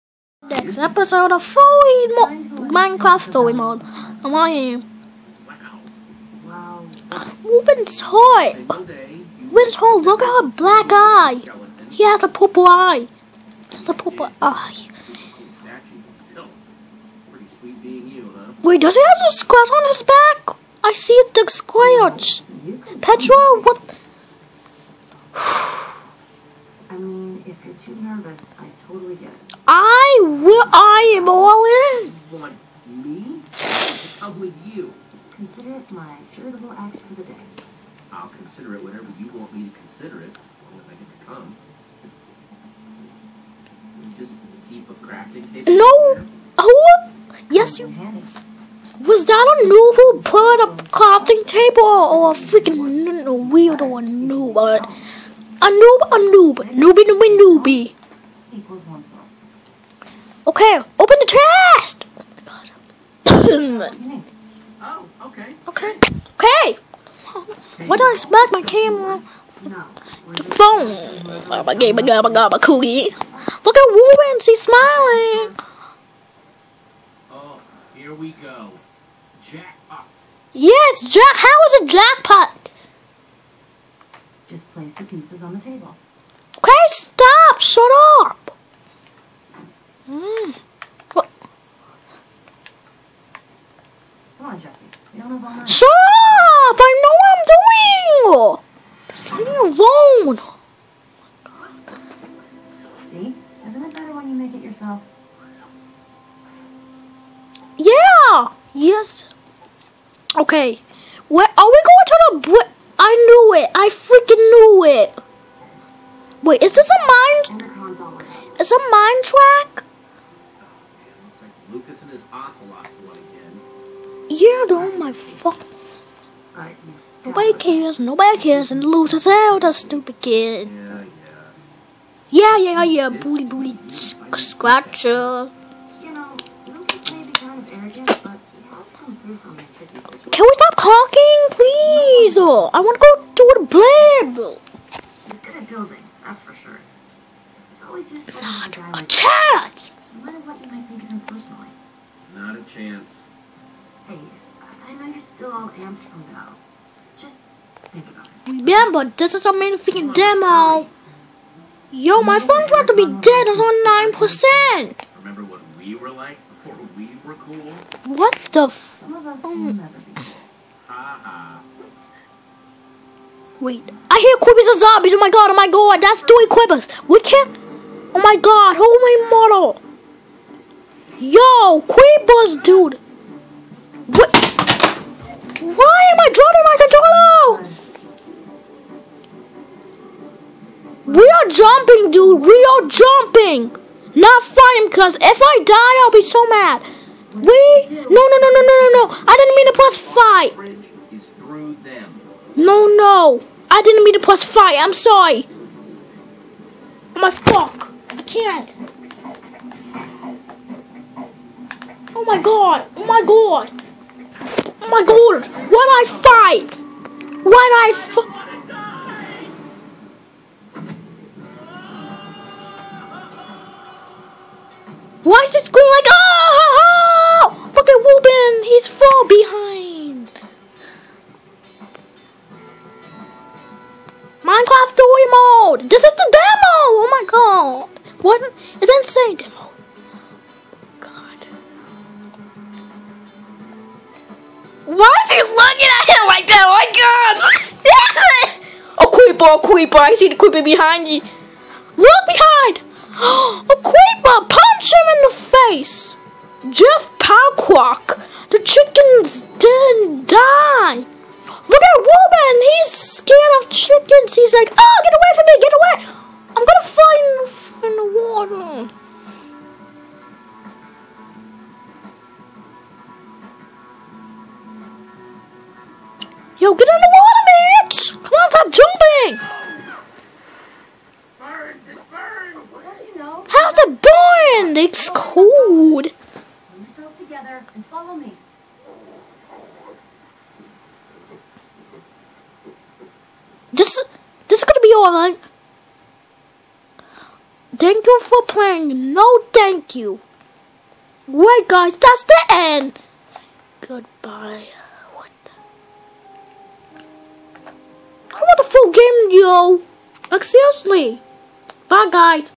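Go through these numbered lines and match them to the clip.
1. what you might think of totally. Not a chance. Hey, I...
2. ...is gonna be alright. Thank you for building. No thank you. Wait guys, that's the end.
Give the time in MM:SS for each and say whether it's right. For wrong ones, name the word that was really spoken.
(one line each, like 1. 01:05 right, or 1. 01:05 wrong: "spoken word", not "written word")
1. 02:30 wrong: "personally", not "totally"
2. 04:54 wrong: "playing", not "building".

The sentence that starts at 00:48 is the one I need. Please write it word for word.
Was that a noob who put a crafting table or a freaking weirdo or a noob?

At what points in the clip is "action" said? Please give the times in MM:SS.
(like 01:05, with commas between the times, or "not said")
00:36.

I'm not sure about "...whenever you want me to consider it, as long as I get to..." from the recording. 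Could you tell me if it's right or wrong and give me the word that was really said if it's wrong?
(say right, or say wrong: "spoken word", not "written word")
right.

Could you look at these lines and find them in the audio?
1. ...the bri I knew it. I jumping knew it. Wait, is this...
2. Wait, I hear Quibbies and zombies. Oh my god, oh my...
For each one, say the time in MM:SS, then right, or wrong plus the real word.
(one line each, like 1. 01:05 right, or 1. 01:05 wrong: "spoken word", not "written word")
1. 01:52 wrong: "freaking", not "jumping"
2. 02:53 right.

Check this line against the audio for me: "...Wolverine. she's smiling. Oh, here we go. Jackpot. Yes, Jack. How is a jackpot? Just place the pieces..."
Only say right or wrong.
right.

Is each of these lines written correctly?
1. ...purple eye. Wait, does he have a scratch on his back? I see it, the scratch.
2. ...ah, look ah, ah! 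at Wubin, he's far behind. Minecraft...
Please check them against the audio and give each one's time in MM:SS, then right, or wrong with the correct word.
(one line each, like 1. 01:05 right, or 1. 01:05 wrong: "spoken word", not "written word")
1. 00:13 right
2. 03:46 right.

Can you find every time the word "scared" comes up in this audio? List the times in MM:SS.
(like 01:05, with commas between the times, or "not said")
04:22.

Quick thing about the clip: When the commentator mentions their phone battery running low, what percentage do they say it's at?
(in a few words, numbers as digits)
9%.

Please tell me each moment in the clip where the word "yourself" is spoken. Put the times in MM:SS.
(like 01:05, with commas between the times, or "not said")
01:44.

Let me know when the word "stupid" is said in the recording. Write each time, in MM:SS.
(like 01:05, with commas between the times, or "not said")
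02:09.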